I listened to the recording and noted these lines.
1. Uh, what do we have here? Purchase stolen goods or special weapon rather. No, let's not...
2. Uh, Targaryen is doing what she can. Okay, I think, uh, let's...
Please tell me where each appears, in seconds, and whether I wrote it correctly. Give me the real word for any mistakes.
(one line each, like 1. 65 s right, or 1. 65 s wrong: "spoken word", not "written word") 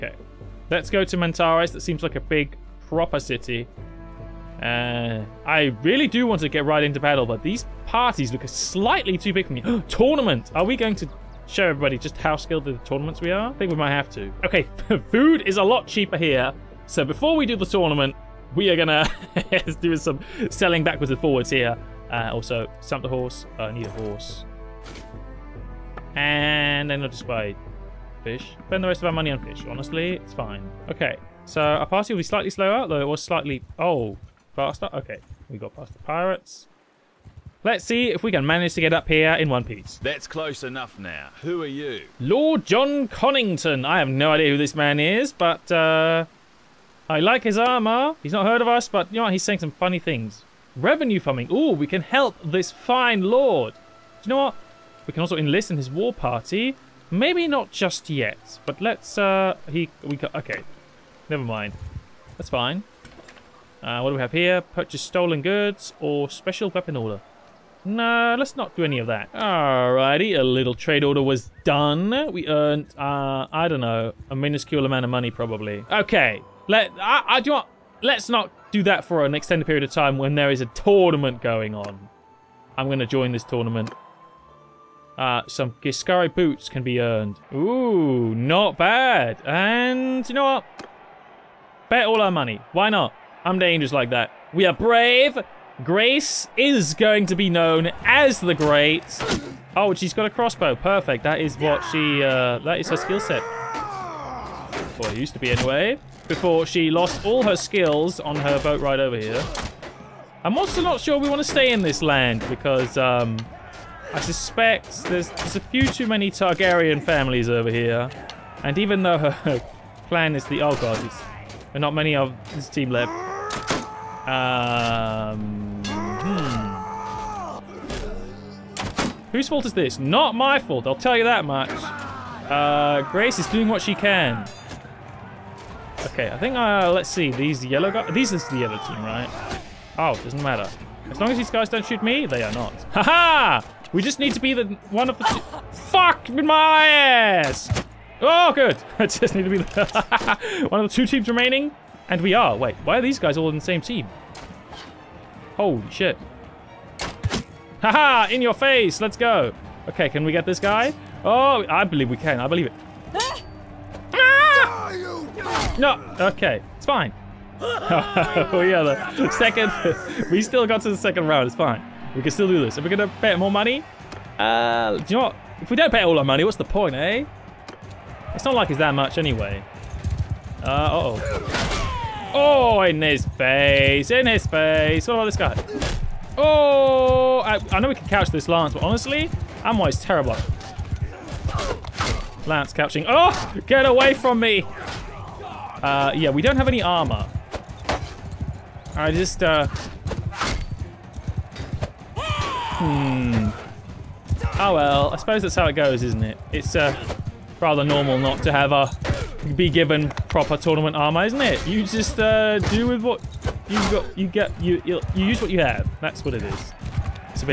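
1. 63 s wrong: "order", not "rather"
2. 132 s wrong: "Grace", not "Targaryen".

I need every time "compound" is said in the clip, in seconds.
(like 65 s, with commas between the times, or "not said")
not said.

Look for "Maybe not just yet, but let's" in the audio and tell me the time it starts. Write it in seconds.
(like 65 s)
57 s.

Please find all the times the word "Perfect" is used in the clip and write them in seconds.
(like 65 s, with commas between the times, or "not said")
100 s.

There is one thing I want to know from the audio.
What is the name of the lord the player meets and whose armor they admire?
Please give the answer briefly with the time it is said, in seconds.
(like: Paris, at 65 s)
Jon Connington, at 42 s.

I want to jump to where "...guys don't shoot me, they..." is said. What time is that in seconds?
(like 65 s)
141 s.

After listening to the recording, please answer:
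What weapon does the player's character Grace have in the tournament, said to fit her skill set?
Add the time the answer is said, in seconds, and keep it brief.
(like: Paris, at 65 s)
Crossbow, at 100 s.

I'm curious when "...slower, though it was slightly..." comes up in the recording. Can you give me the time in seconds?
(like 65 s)
32 s.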